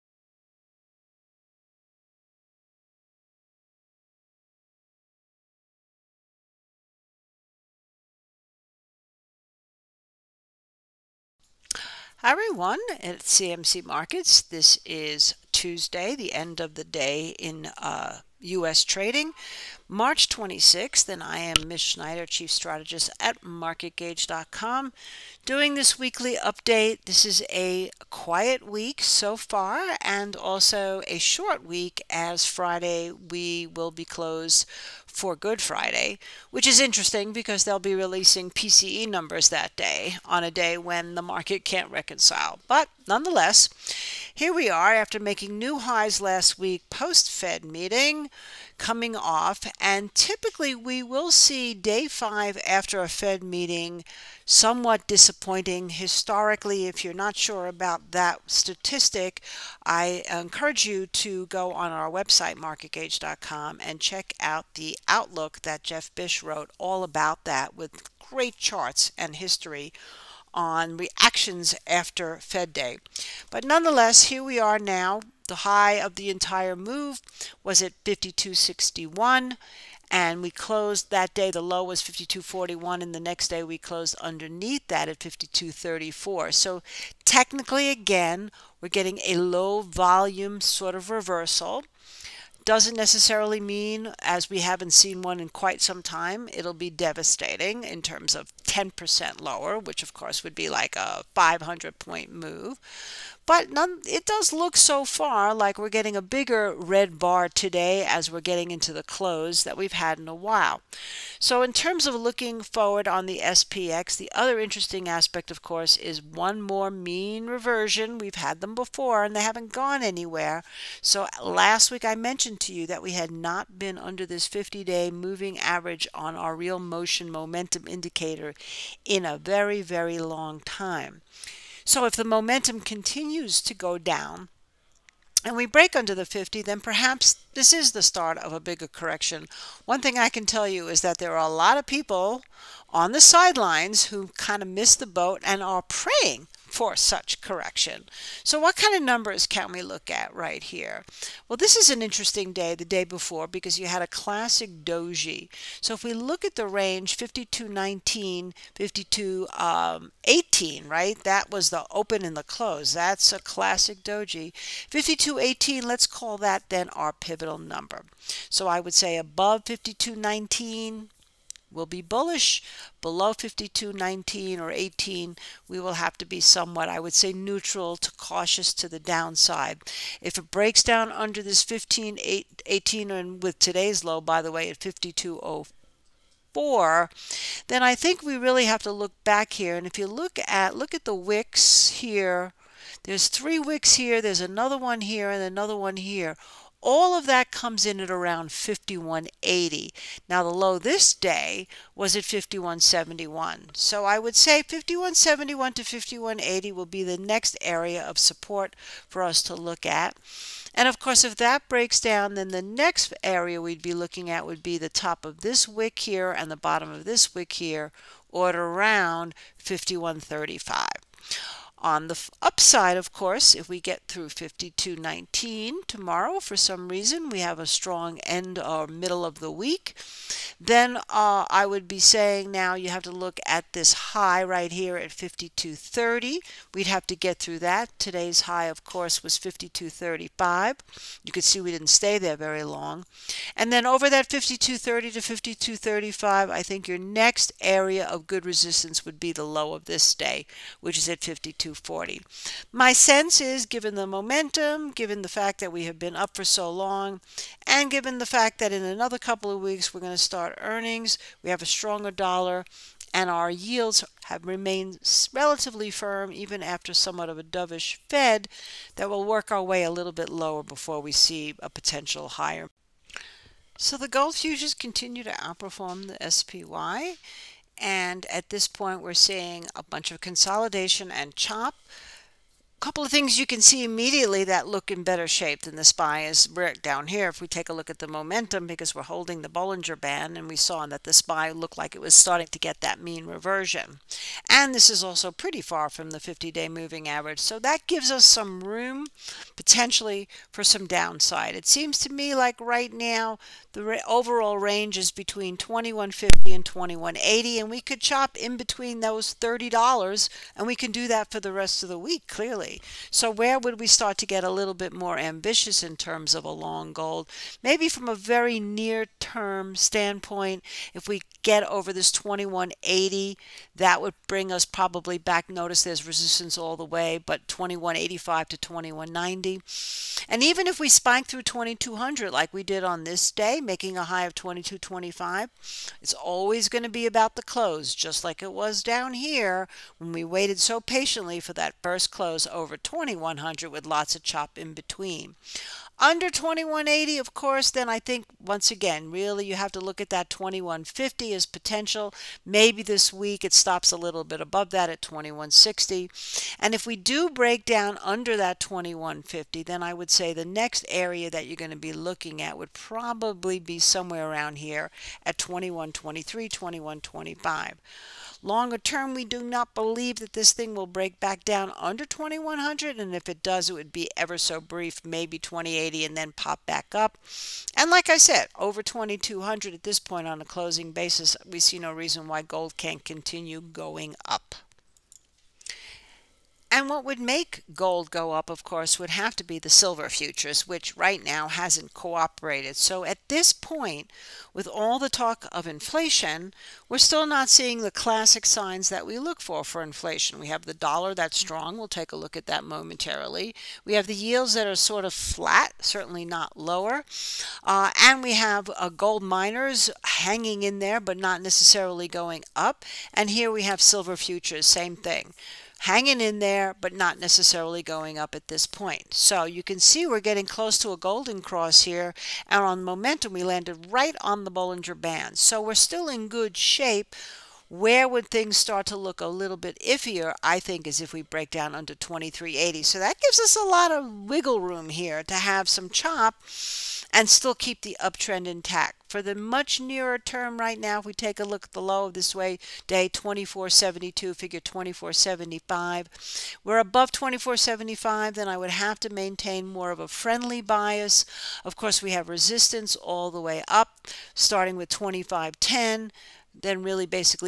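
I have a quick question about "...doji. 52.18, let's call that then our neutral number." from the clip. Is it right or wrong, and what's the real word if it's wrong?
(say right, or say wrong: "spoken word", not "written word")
wrong: "pivotal", not "neutral".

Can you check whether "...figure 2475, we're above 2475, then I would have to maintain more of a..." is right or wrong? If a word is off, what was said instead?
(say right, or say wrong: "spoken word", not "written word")
right.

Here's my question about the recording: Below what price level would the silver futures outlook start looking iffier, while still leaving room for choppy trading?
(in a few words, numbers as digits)
2380.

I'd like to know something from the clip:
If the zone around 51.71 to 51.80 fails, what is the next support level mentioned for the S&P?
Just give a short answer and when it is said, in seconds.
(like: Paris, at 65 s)
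51.35, at 219 s.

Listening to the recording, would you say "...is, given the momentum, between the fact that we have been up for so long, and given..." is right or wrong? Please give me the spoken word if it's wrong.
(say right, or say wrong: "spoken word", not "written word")
wrong: "given", not "between".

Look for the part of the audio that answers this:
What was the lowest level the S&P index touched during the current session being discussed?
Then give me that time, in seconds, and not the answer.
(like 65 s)
184 s.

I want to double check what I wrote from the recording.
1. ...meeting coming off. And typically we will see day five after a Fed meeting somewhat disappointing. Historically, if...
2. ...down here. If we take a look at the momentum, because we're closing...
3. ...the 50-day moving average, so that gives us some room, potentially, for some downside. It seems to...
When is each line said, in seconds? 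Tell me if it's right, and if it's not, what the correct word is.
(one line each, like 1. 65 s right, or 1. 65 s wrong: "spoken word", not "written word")
1. 47 s right
2. 286 s wrong: "holding", not "closing"
3. 296 s right.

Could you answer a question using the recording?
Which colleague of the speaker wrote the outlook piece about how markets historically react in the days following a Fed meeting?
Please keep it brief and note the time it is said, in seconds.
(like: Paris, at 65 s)
Geoff Bysshe, at 65 s.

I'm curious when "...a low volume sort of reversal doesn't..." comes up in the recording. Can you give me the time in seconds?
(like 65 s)
89 s.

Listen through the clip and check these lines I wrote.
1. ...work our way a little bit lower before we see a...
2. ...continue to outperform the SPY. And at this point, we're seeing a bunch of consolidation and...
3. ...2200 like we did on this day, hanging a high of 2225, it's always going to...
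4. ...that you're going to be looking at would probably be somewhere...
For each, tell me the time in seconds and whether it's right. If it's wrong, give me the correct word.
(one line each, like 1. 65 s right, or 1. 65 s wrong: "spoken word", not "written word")
1. 269 s right
2. 274 s right
3. 331 s wrong: "making", not "hanging"
4. 361 s right.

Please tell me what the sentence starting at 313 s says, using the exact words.
So where would we start to get a little bit more ambitious in terms of a long goal?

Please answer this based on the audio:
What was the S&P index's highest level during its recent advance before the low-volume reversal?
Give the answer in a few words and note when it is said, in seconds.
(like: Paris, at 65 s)
52.61, at 78 s.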